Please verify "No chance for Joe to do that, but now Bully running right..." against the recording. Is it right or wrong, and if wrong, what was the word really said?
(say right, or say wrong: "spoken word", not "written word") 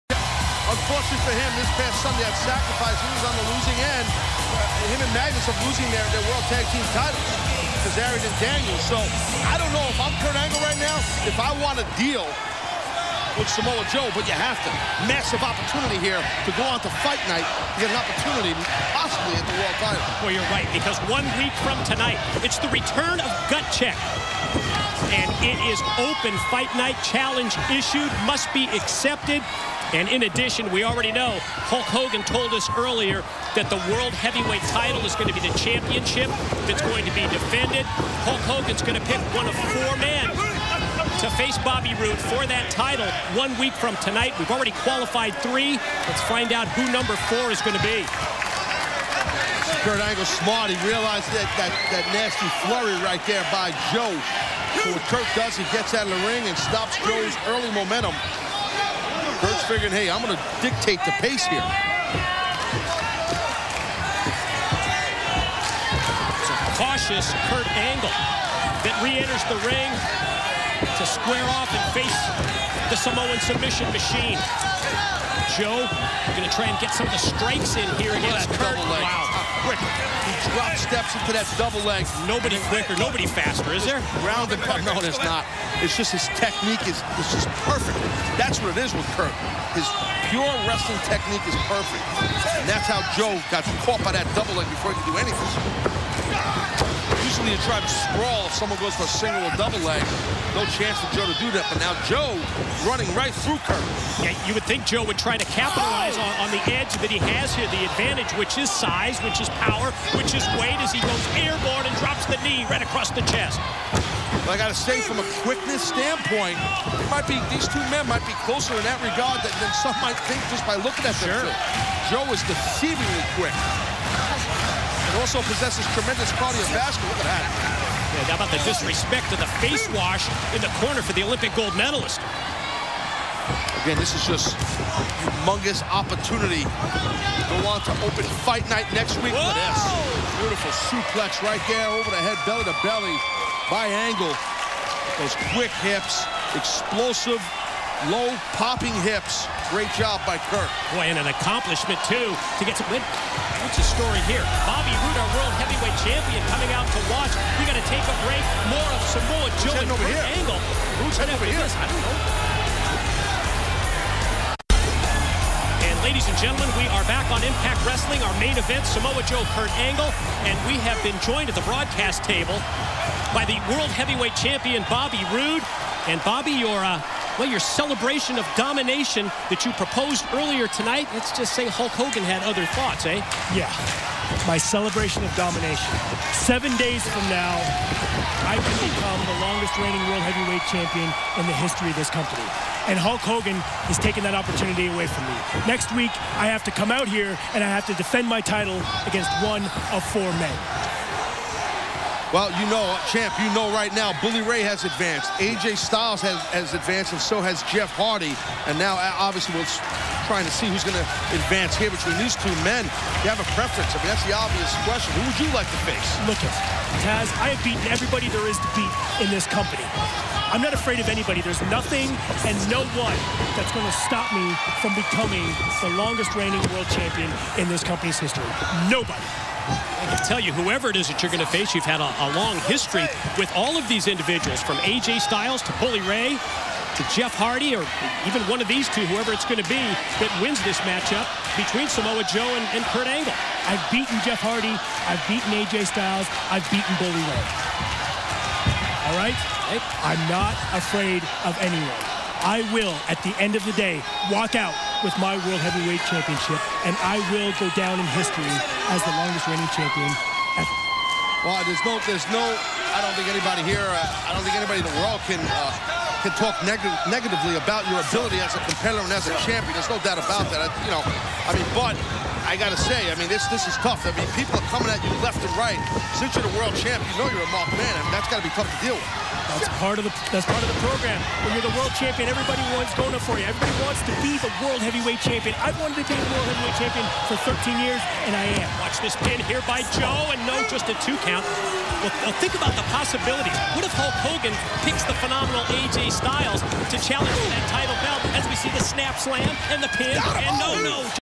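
wrong: "Joe", not "Bully".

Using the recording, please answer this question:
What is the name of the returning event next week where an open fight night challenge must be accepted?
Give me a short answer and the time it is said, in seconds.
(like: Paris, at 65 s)
Gut Check, at 23 s.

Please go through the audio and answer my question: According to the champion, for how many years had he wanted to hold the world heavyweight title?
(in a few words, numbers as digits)
13.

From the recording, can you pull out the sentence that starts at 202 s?
Well, you know, champ, you know right now, Bully Ray has advanced.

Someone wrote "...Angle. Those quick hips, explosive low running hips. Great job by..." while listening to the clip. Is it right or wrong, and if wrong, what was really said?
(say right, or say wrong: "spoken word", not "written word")
wrong: "popping", not "running".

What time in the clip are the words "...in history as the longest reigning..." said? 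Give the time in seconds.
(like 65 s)
258 s.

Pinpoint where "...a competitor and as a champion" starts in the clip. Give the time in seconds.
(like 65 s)
268 s.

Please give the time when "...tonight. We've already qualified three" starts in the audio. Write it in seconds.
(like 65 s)
43 s.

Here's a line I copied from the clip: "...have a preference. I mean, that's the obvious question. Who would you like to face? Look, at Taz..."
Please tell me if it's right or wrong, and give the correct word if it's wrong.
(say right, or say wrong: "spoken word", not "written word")
right.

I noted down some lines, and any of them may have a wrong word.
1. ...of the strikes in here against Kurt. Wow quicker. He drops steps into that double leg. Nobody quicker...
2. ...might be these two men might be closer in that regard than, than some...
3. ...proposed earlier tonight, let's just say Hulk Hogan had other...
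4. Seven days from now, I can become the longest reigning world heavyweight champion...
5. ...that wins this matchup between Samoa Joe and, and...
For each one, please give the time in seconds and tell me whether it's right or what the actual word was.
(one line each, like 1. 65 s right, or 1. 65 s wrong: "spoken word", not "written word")
1. 77 s right
2. 117 s right
3. 179 s right
4. 186 s right
5. 240 s right.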